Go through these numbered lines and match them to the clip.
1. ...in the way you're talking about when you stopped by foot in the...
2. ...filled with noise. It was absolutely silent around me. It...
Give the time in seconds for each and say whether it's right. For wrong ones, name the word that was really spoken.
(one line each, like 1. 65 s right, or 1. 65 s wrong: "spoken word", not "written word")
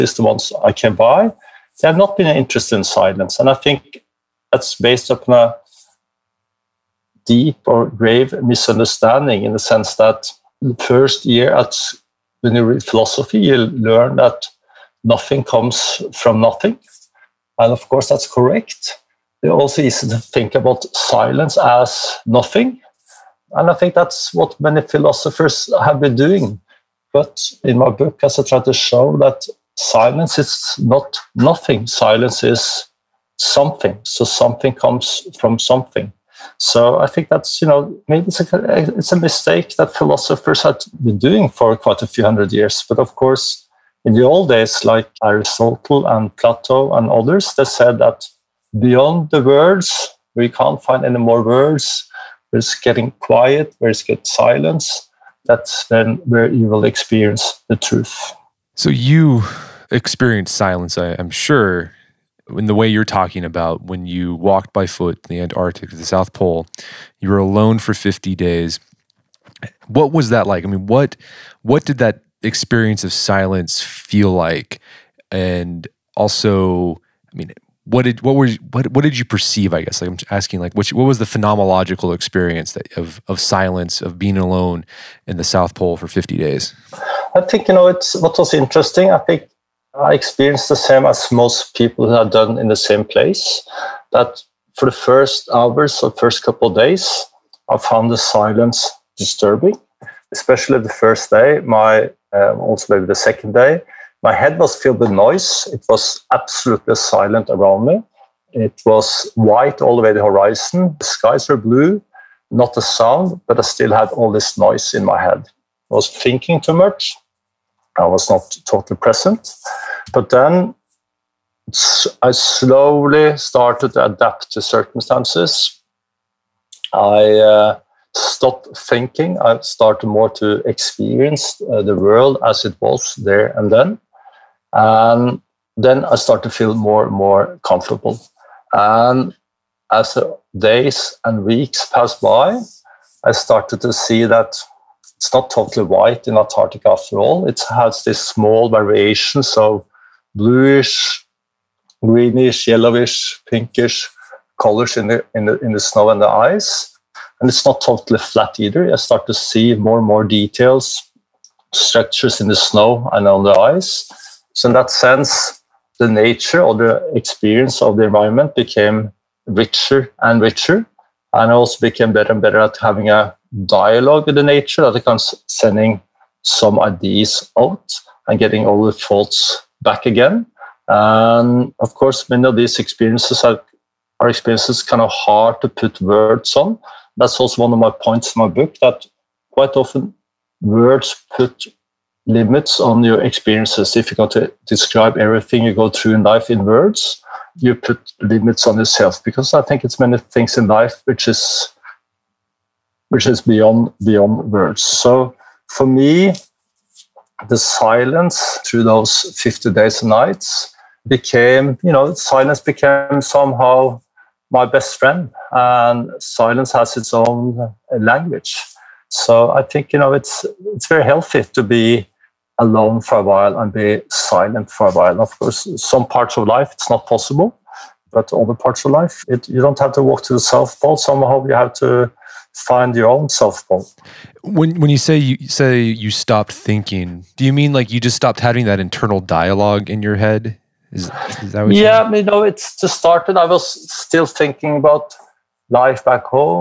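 1. 62 s wrong: "walked", not "stopped"
2. 104 s right.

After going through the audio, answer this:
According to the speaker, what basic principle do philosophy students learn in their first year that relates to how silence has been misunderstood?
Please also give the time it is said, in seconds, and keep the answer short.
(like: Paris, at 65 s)
Nothing comes from nothing, at 15 s.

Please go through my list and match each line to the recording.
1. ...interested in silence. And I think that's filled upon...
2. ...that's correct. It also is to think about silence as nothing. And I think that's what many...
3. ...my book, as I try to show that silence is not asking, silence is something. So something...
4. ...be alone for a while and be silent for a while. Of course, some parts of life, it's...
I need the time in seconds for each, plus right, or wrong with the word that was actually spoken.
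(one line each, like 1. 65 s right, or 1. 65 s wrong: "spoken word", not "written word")
1. 2 s wrong: "based", not "filled"
2. 18 s right
3. 27 s wrong: "nothing", not "asking"
4. 221 s right.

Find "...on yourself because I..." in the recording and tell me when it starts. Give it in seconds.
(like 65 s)
198 s.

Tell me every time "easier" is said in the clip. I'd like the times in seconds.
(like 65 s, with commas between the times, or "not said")
not said.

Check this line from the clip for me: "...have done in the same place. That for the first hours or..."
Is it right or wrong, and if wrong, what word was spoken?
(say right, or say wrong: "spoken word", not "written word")
right.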